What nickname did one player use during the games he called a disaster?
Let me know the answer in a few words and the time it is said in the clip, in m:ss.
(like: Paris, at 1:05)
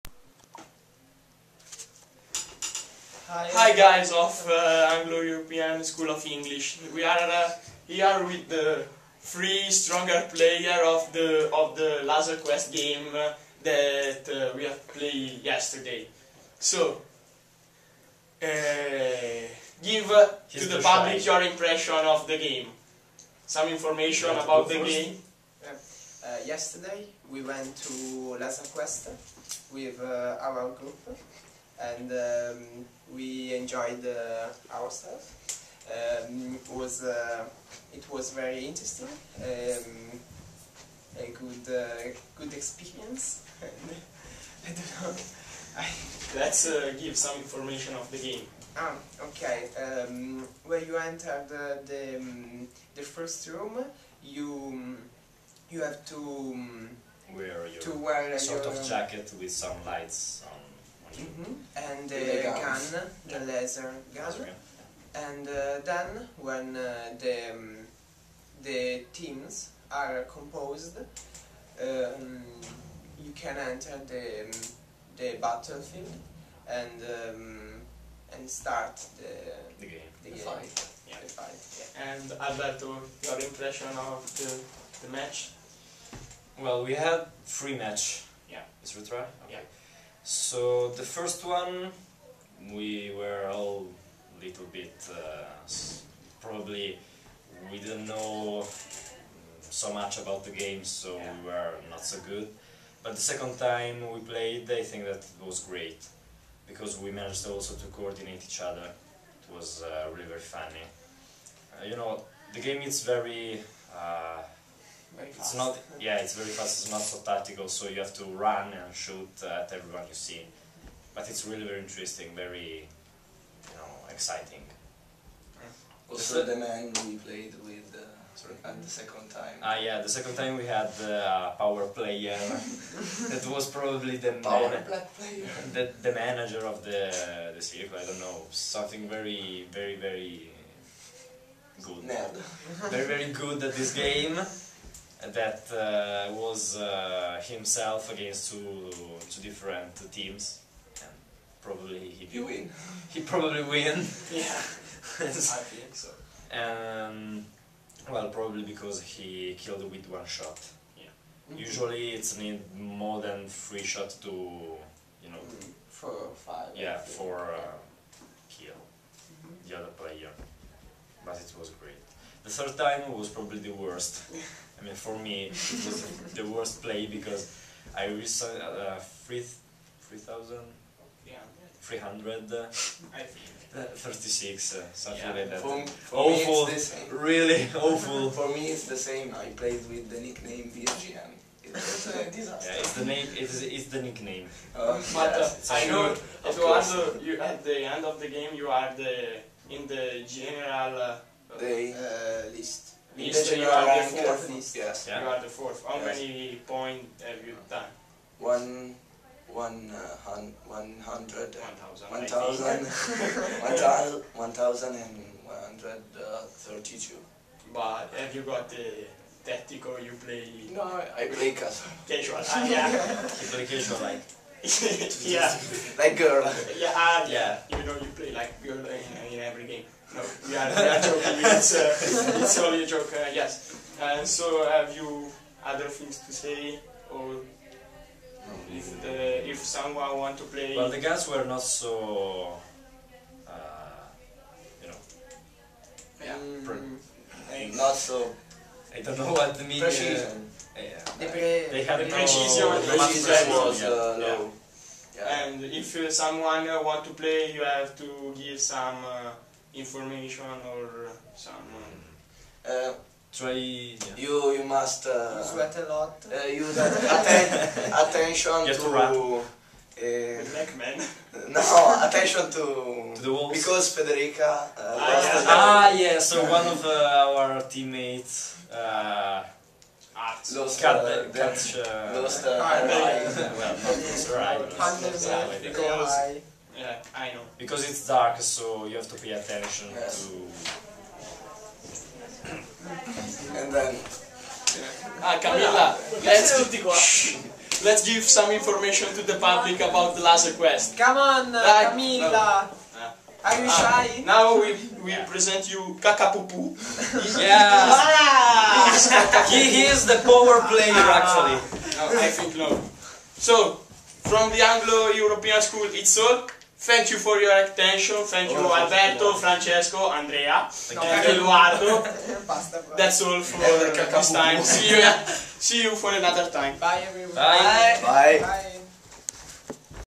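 virgin, at 3:10.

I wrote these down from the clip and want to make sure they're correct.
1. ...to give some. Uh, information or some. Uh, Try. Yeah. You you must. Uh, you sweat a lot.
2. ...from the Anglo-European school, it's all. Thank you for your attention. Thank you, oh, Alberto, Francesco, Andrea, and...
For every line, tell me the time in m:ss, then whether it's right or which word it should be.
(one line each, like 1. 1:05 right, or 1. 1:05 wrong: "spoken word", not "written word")
1. 4:17 right
2. 5:14 right.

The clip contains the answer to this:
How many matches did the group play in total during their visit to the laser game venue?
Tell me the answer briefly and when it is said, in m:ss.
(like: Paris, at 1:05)
3, at 1:27.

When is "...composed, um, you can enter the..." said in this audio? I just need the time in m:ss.
1:10.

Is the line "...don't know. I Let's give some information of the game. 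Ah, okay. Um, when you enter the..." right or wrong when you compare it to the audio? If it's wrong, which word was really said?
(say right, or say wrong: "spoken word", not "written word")
right.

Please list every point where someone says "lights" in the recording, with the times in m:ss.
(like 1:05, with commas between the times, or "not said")
0:59.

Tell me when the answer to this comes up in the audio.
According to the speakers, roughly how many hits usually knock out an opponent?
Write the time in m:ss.
2:45.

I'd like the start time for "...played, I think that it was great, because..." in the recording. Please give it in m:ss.
1:44.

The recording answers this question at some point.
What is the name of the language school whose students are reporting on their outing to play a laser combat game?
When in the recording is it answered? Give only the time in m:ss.
0:04.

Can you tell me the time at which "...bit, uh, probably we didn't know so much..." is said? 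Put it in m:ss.
1:34.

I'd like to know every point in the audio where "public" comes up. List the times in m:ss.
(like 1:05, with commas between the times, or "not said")
0:20, 4:59.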